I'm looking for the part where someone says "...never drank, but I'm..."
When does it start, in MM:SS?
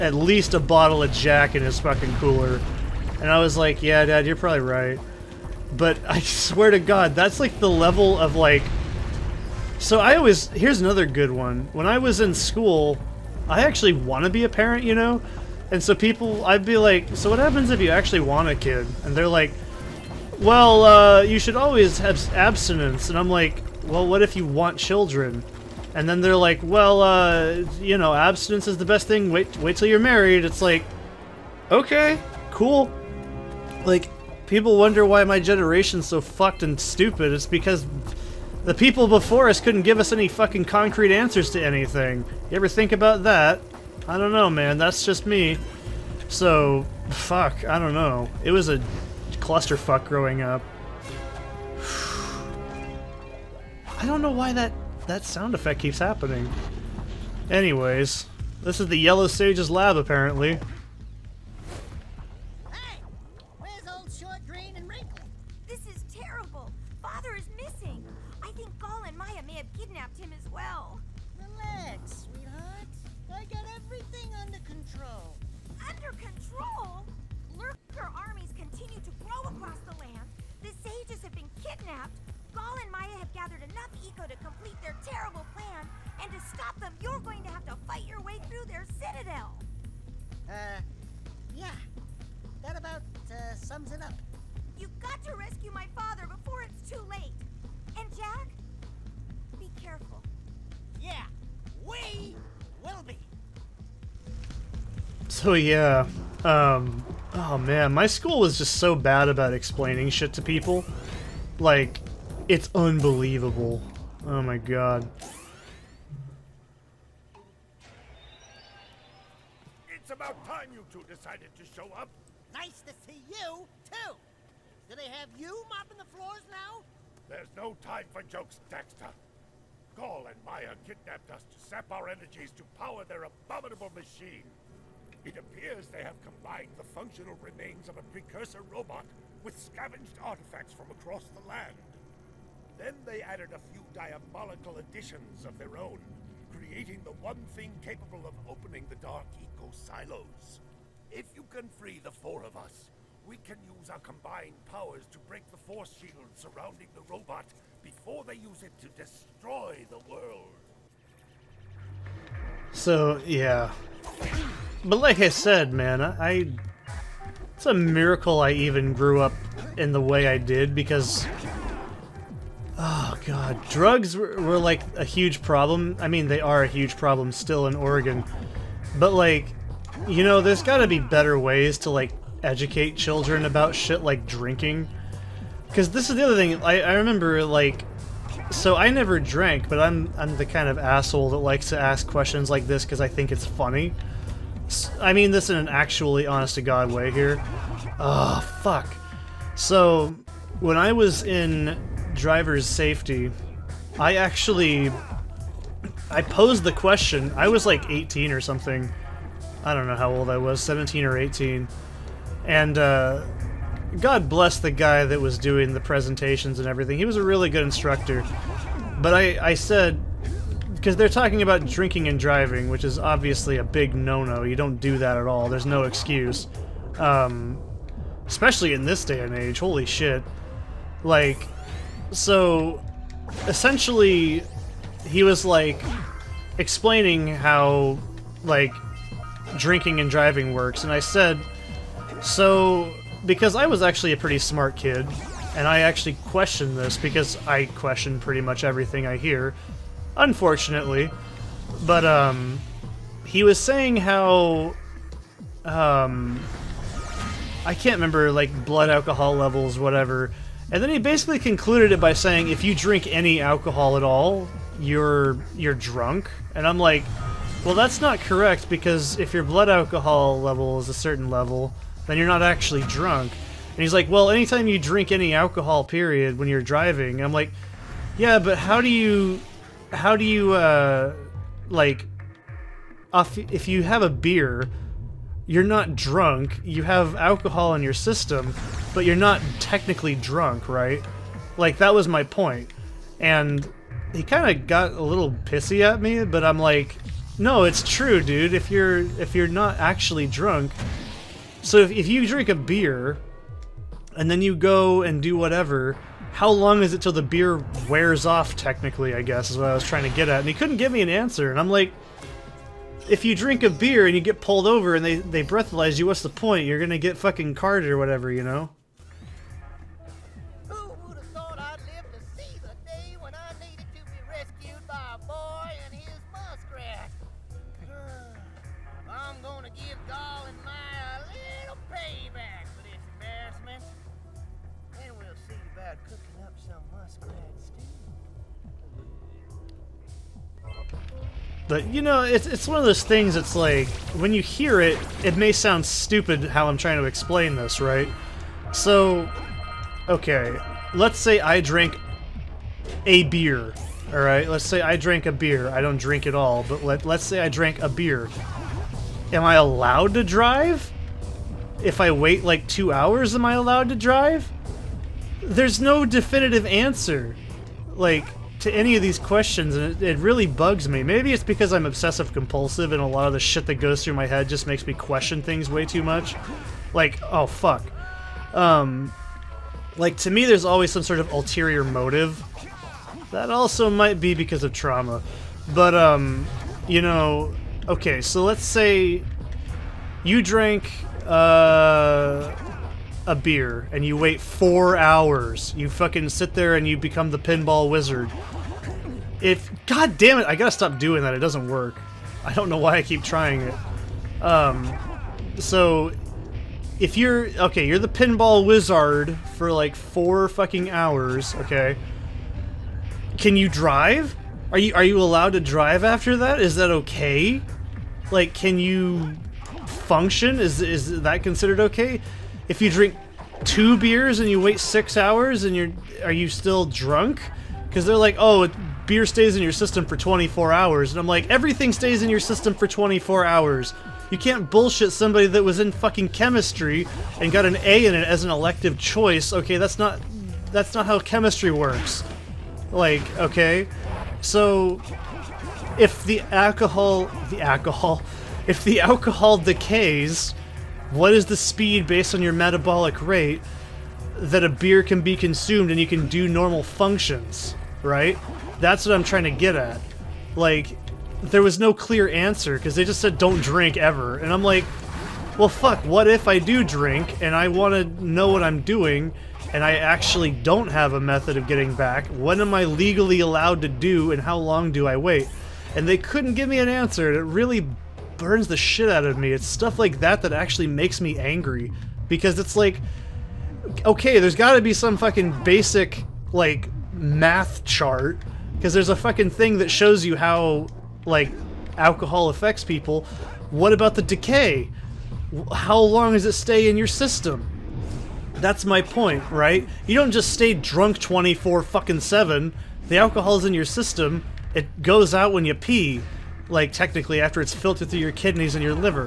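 03:08.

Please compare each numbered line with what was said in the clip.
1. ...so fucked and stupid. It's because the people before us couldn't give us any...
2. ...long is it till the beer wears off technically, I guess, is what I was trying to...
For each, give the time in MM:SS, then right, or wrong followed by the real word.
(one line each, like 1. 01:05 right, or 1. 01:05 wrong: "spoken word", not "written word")
1. 00:36 right
2. 05:06 right.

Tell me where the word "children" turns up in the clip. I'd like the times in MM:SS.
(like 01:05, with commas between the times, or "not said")
00:24, 03:02.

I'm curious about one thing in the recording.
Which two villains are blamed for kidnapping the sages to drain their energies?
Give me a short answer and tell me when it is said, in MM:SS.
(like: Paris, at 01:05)
Gol and Maia, at 02:09.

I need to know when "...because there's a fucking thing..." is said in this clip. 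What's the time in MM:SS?
08:08.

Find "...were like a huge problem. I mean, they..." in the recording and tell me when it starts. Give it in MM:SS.
02:54.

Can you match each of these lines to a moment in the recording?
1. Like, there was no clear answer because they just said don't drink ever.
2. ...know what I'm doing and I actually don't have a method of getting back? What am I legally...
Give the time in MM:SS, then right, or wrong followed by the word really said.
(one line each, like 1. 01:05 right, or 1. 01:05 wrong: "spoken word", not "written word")
1. 07:40 right
2. 07:48 right.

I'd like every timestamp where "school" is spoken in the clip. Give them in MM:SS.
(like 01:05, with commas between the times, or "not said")
00:12, 01:48.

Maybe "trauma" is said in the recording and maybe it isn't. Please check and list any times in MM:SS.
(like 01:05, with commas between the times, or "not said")
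06:24.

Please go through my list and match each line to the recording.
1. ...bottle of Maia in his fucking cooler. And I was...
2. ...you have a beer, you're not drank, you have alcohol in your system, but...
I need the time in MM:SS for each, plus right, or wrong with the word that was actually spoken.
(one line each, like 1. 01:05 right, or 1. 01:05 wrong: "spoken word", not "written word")
1. 00:00 wrong: "Jack", not "Maia"
2. 04:43 wrong: "drunk", not "drank".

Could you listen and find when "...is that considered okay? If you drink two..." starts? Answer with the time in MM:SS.
07:00.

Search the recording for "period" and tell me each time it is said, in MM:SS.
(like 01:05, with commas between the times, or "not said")
04:35.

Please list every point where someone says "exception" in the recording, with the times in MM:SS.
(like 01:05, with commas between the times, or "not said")
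not said.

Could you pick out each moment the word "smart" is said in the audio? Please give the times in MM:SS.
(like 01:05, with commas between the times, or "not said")
04:04.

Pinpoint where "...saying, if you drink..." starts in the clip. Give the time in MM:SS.
04:22.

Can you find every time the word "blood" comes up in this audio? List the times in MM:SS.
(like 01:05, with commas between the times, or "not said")
04:18, 04:29.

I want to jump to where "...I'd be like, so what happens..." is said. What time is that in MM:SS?
00:16.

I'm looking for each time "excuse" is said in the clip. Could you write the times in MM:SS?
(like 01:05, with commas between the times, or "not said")
03:45.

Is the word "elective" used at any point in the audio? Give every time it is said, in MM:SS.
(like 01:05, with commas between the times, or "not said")
07:18.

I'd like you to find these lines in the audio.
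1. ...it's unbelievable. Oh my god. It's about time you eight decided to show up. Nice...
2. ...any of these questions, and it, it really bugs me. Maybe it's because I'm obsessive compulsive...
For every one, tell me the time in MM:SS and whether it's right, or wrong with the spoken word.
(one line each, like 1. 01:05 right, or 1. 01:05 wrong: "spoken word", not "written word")
1. 01:52 wrong: "two", not "eight"
2. 06:08 right.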